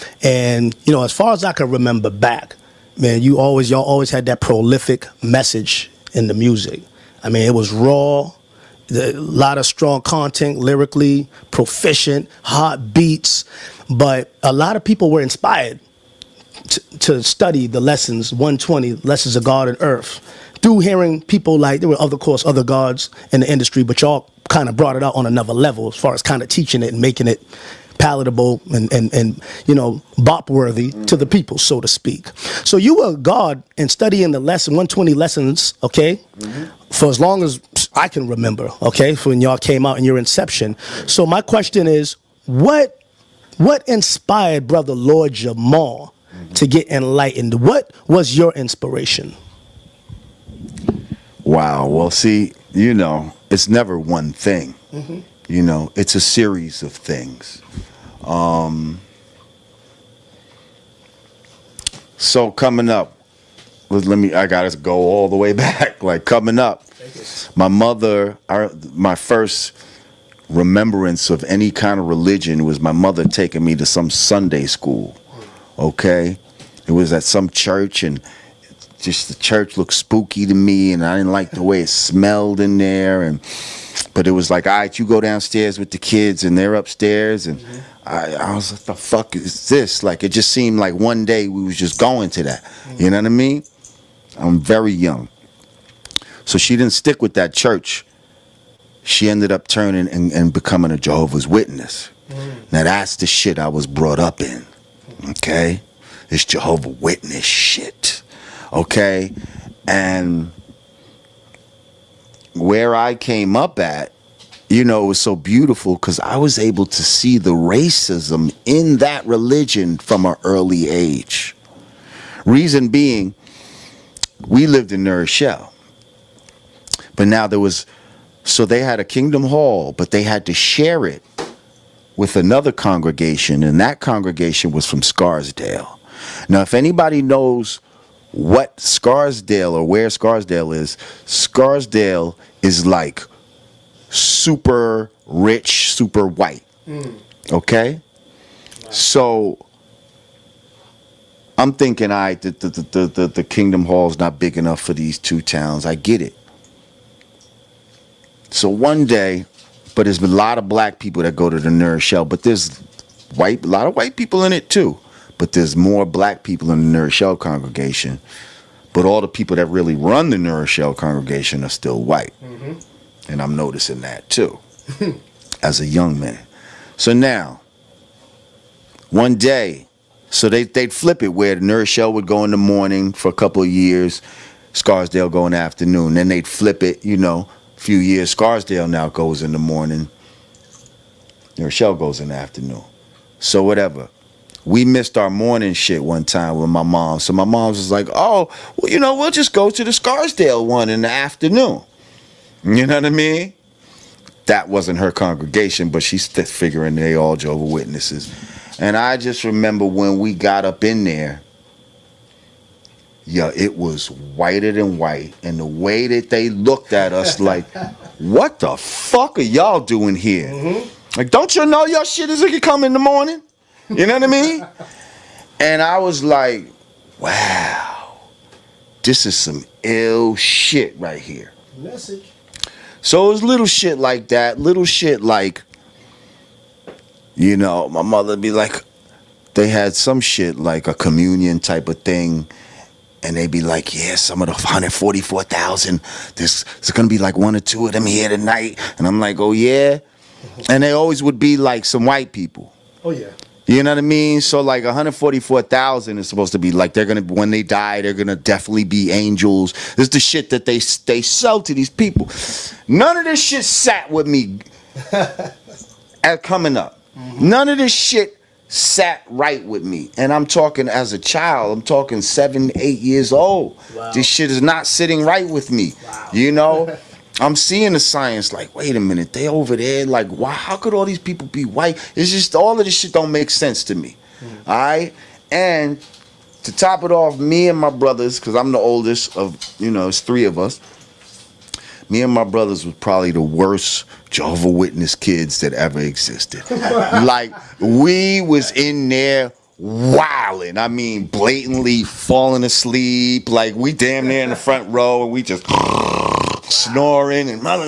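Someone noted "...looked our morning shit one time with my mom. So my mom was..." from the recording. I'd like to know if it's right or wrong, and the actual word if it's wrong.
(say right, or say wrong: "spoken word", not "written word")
wrong: "missed", not "looked".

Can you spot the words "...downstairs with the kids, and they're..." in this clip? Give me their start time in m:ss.
1:25.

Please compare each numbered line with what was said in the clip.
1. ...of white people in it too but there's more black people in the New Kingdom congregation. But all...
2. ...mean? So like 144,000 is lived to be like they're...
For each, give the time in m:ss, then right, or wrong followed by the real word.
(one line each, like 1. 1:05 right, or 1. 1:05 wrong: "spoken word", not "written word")
1. 2:43 wrong: "Rochelle", not "Kingdom"
2. 4:14 wrong: "supposed", not "lived".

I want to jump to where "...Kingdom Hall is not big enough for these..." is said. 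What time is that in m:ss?
2:33.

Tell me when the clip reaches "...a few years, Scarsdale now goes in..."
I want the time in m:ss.
3:07.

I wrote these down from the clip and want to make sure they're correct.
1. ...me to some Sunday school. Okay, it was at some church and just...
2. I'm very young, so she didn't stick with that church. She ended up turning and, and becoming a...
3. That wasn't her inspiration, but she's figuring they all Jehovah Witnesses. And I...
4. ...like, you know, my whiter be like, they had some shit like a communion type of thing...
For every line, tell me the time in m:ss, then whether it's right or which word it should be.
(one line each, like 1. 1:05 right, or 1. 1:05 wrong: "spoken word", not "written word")
1. 1:13 right
2. 1:34 right
3. 3:24 wrong: "congregation", not "inspiration"
4. 3:55 wrong: "mother", not "whiter".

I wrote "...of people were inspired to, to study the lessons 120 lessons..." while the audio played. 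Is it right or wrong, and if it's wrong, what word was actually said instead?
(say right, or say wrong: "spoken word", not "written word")
right.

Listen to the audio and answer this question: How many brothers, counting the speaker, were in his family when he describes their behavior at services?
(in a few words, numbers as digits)
3.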